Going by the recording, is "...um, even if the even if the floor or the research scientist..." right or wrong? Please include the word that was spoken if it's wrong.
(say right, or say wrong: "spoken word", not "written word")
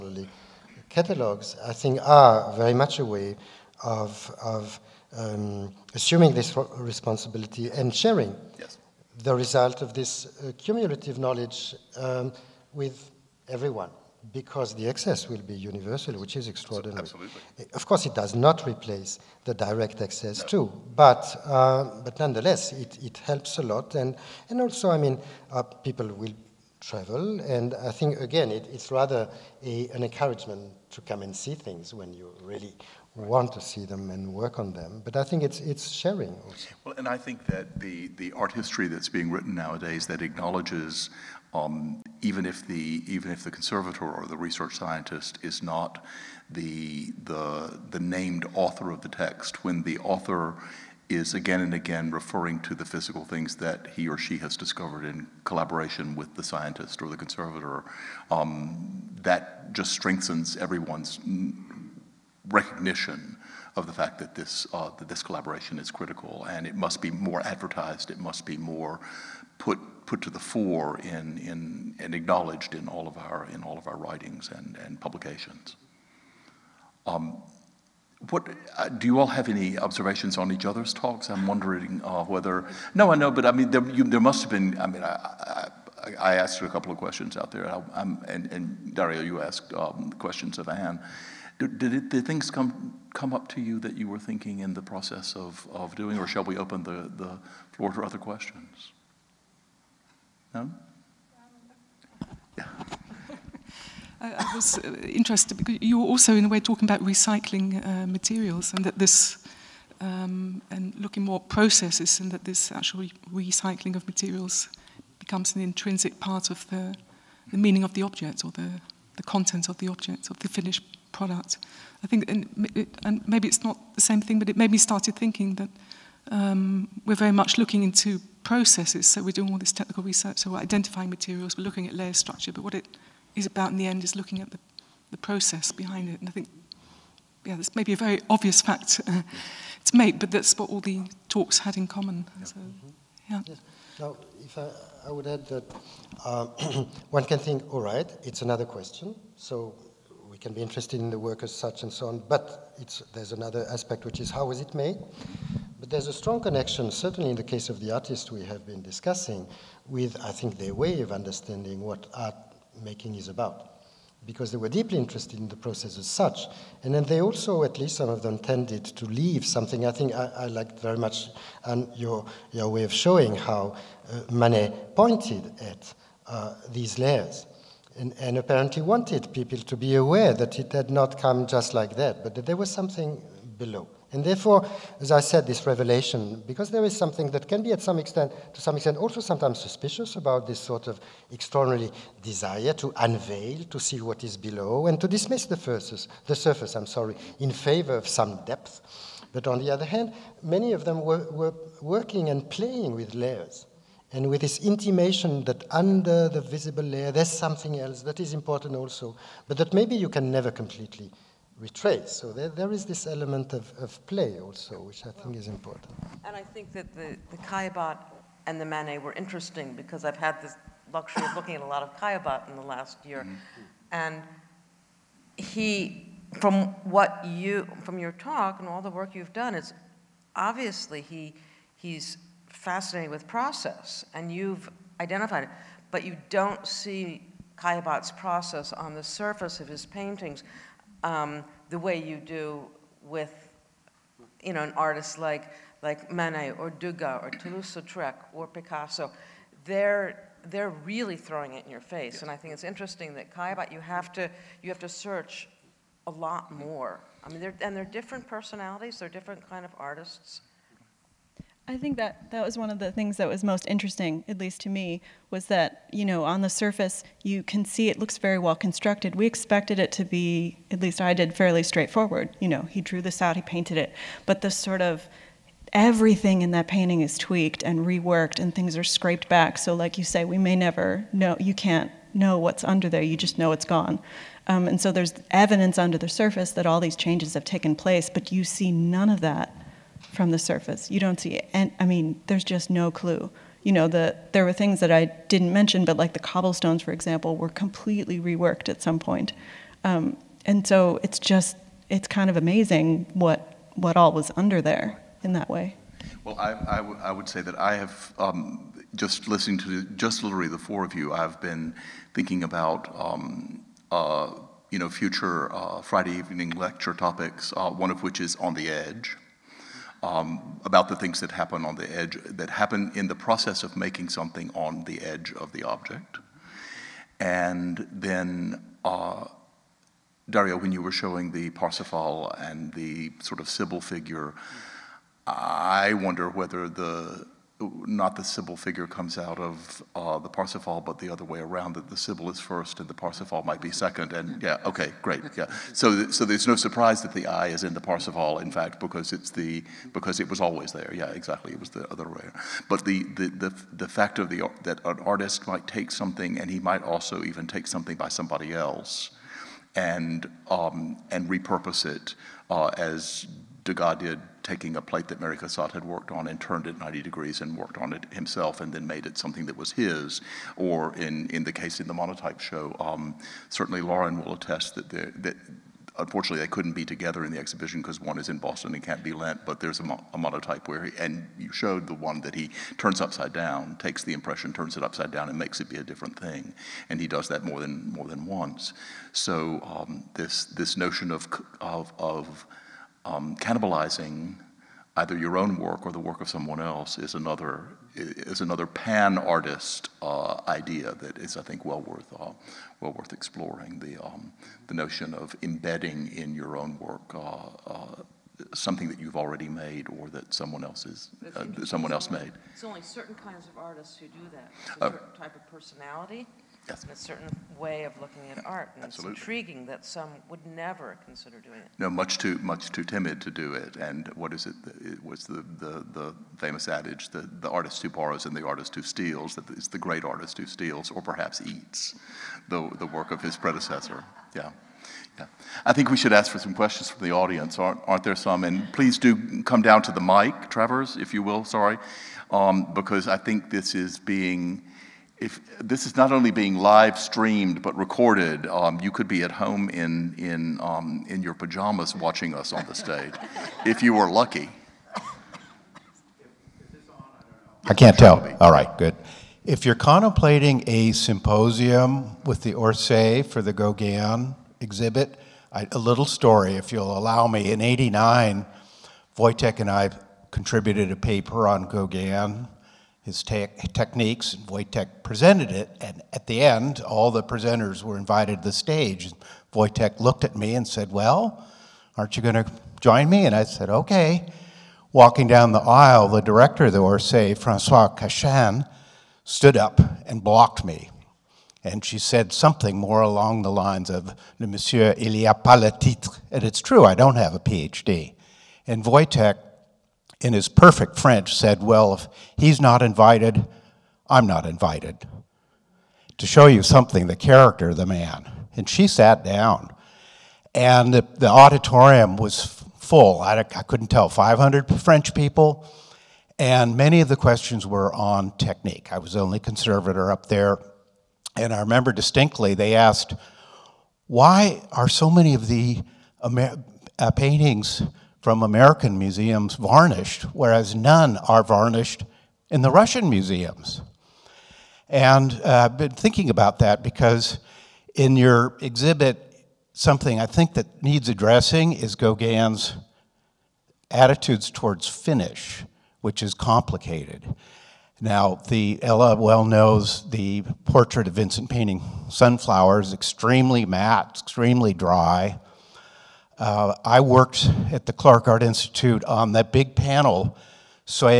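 wrong: "conservator", not "floor".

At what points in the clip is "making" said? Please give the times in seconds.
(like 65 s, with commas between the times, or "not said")
162 s, 323 s.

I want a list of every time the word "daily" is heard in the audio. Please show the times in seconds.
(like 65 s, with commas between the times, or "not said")
not said.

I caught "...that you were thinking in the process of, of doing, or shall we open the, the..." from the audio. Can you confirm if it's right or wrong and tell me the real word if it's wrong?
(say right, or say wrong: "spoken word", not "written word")
right.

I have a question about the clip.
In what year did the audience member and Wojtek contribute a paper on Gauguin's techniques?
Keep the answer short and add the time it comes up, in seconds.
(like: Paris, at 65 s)
1989, at 467 s.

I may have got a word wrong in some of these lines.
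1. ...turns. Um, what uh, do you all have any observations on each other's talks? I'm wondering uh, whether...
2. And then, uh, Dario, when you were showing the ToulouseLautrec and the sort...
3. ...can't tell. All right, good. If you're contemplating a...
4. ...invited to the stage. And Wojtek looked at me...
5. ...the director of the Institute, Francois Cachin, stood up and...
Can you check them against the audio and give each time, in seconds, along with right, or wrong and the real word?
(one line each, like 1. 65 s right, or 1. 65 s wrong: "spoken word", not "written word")
1. 74 s wrong: "publications", not "turns"
2. 327 s wrong: "Parsifal", not "ToulouseLautrec"
3. 457 s right
4. 477 s right
5. 486 s wrong: "Orsay", not "Institute".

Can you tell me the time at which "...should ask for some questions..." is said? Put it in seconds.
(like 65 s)
435 s.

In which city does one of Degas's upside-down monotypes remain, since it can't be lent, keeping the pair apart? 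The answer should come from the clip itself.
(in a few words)
Boston.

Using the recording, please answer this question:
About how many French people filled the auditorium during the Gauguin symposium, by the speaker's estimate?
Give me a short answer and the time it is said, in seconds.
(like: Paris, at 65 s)
500, at 514 s.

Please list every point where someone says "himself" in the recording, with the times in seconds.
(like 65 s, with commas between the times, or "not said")
368 s.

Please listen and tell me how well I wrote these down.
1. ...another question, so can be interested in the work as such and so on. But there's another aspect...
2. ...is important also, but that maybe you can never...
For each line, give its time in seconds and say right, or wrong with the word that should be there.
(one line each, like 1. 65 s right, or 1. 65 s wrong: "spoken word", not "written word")
1. 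148 s right
2. 208 s right.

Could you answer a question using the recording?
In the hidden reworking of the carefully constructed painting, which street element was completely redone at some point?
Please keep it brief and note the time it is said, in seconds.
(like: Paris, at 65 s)
The cobblestones, at 296 s.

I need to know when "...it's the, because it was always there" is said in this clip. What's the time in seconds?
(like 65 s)
349 s.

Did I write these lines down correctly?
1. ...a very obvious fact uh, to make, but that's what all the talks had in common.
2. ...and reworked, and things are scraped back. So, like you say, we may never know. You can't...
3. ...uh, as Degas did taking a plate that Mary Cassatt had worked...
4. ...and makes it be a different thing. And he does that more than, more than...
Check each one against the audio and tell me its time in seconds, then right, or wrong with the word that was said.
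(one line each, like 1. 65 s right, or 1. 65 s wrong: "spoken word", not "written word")
1. 137 s right
2. 277 s right
3. 362 s right
4. 385 s right.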